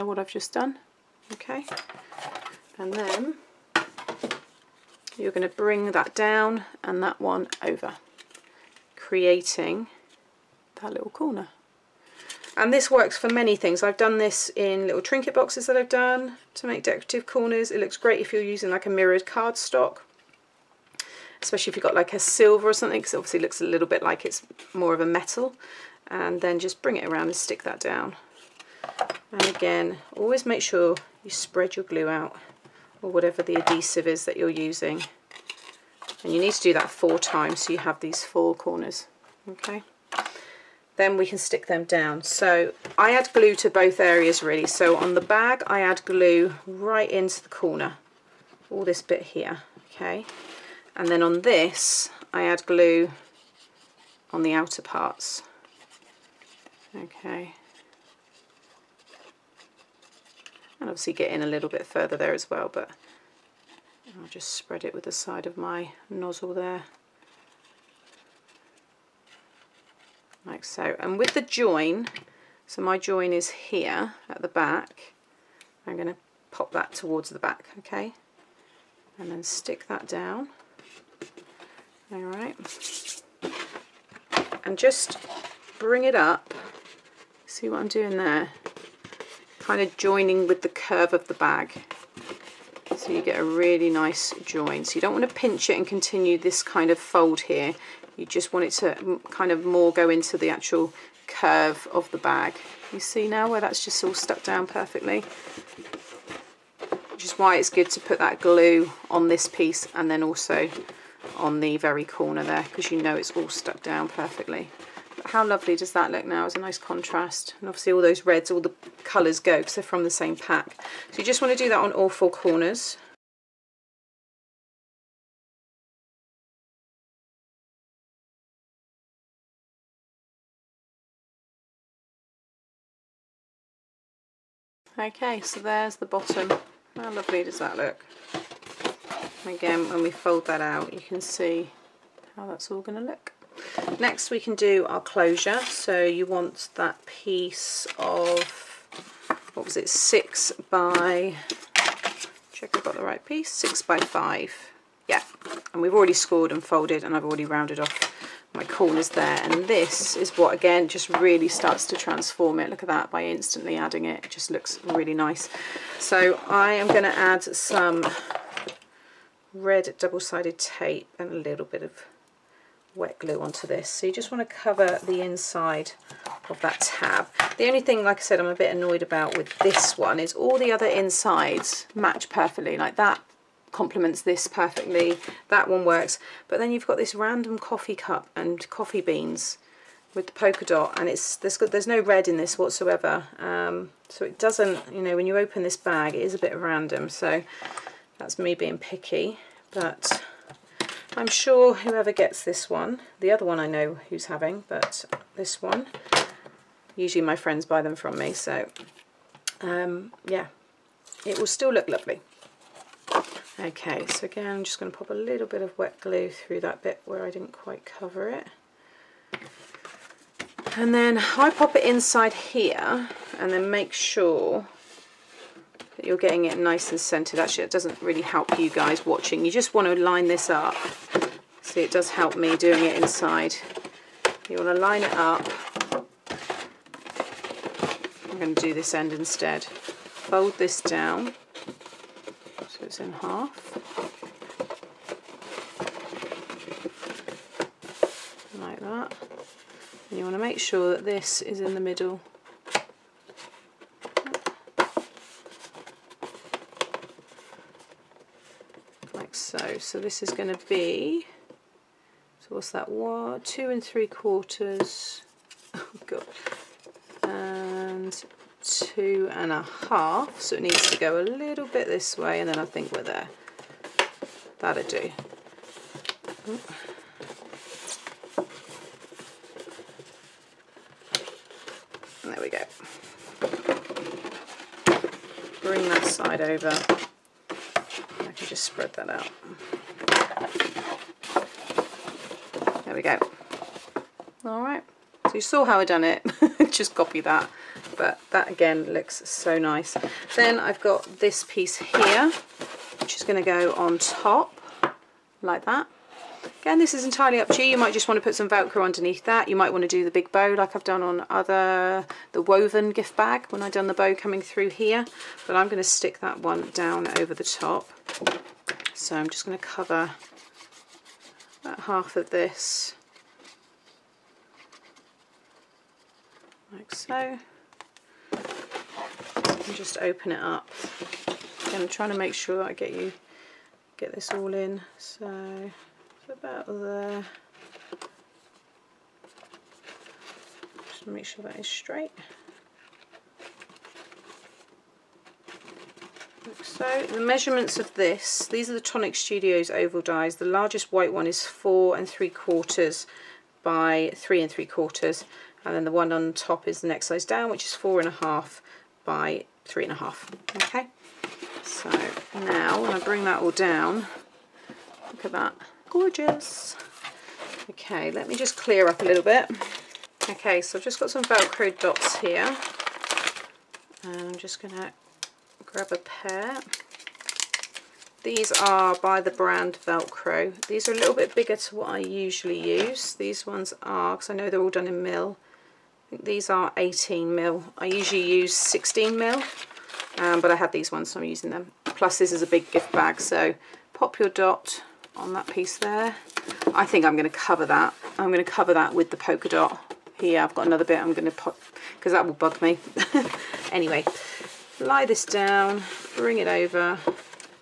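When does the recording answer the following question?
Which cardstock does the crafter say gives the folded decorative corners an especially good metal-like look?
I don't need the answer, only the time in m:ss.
0:18.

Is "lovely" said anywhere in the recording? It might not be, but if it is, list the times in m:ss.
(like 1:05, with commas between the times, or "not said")
1:55, 2:17, 3:31.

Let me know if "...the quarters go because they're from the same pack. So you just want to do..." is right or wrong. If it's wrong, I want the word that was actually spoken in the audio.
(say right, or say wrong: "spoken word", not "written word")
wrong: "colours", not "quarters".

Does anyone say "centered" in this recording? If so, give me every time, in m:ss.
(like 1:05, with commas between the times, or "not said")
3:46.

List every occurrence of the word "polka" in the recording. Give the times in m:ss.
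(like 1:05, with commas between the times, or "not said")
3:10, 6:39.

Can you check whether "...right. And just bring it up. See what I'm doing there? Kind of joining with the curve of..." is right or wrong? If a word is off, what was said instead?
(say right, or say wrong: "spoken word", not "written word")
right.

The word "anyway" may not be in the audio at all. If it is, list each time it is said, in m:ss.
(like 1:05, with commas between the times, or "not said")
6:43.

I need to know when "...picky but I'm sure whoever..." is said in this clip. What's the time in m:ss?
3:18.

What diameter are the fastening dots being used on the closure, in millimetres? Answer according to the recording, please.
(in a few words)
18 mm.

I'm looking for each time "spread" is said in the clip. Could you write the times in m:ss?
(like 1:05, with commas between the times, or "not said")
0:31, 1:04, 4:48.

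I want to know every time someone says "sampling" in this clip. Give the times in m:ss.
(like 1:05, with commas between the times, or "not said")
not said.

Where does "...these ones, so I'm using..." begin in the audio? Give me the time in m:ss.
6:30.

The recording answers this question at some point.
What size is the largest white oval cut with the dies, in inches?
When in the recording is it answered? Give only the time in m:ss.
5:51.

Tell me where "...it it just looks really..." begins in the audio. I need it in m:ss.
2:44.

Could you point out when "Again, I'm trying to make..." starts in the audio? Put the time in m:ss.
5:31.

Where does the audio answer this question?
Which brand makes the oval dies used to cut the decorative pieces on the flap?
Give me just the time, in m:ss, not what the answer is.
5:48.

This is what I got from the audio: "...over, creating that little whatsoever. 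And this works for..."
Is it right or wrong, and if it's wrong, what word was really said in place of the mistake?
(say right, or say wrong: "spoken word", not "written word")
wrong: "corner", not "whatsoever".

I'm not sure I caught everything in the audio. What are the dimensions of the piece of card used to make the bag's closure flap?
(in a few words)
6 by 5.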